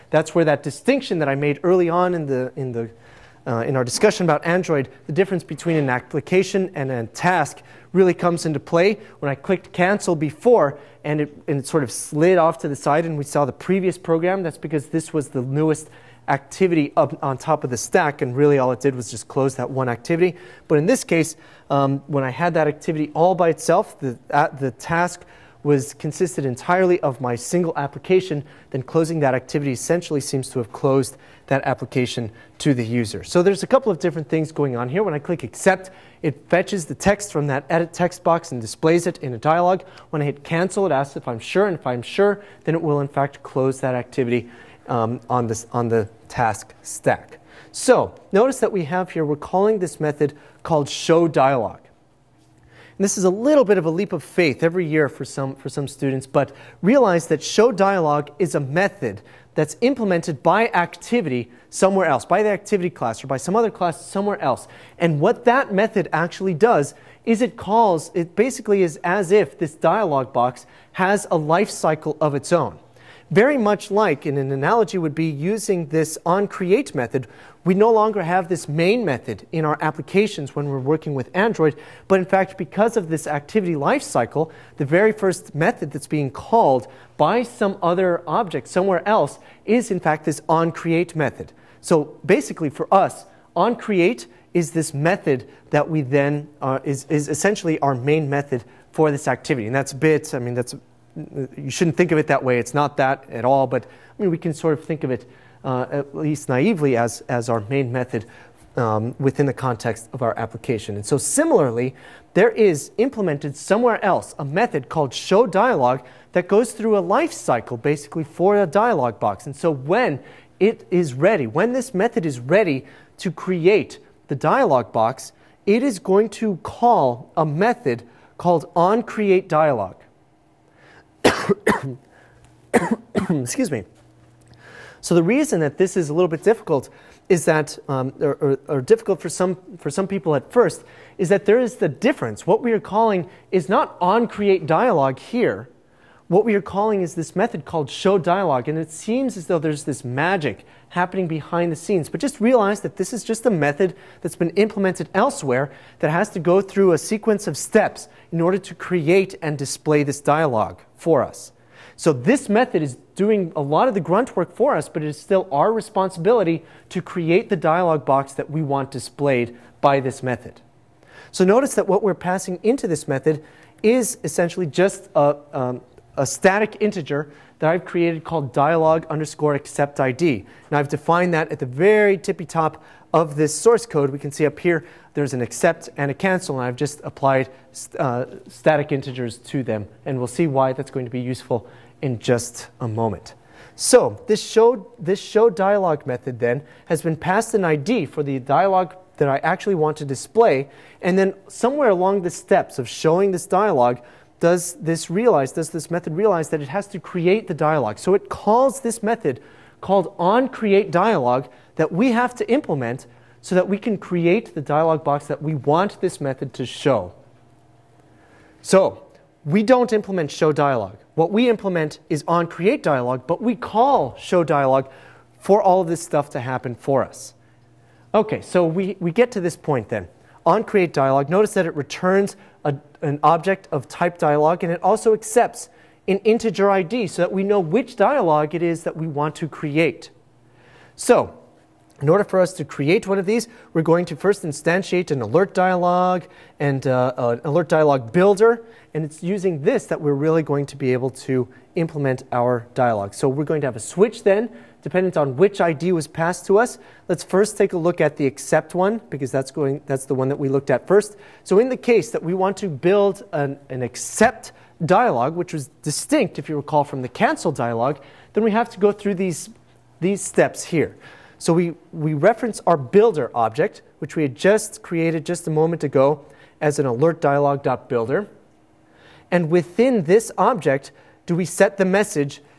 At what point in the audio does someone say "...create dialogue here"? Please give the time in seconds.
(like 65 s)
144 s.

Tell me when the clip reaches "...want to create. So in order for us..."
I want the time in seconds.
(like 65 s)
239 s.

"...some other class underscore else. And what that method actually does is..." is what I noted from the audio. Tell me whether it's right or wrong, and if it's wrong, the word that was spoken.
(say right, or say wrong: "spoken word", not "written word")
wrong: "somewhere", not "underscore".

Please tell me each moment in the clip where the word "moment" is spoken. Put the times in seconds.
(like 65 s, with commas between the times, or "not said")
192 s, 275 s.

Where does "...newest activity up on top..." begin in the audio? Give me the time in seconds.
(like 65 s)
15 s.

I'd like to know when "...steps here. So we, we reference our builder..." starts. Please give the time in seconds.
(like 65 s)
270 s.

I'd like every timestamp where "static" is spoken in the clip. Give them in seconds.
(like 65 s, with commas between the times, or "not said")
176 s, 188 s.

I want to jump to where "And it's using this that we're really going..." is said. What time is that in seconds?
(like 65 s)
248 s.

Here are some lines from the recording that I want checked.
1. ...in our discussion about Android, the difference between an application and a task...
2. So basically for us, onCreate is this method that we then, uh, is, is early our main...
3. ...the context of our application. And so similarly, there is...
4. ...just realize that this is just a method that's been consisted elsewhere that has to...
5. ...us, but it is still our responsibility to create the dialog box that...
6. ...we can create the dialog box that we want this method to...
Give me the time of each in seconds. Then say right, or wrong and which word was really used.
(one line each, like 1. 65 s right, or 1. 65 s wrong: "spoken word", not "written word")
1. 3 s right
2. 91 s wrong: "essentially", not "early"
3. 109 s right
4. 152 s wrong: "implemented", not "consisted"
5. 164 s right
6. 213 s right.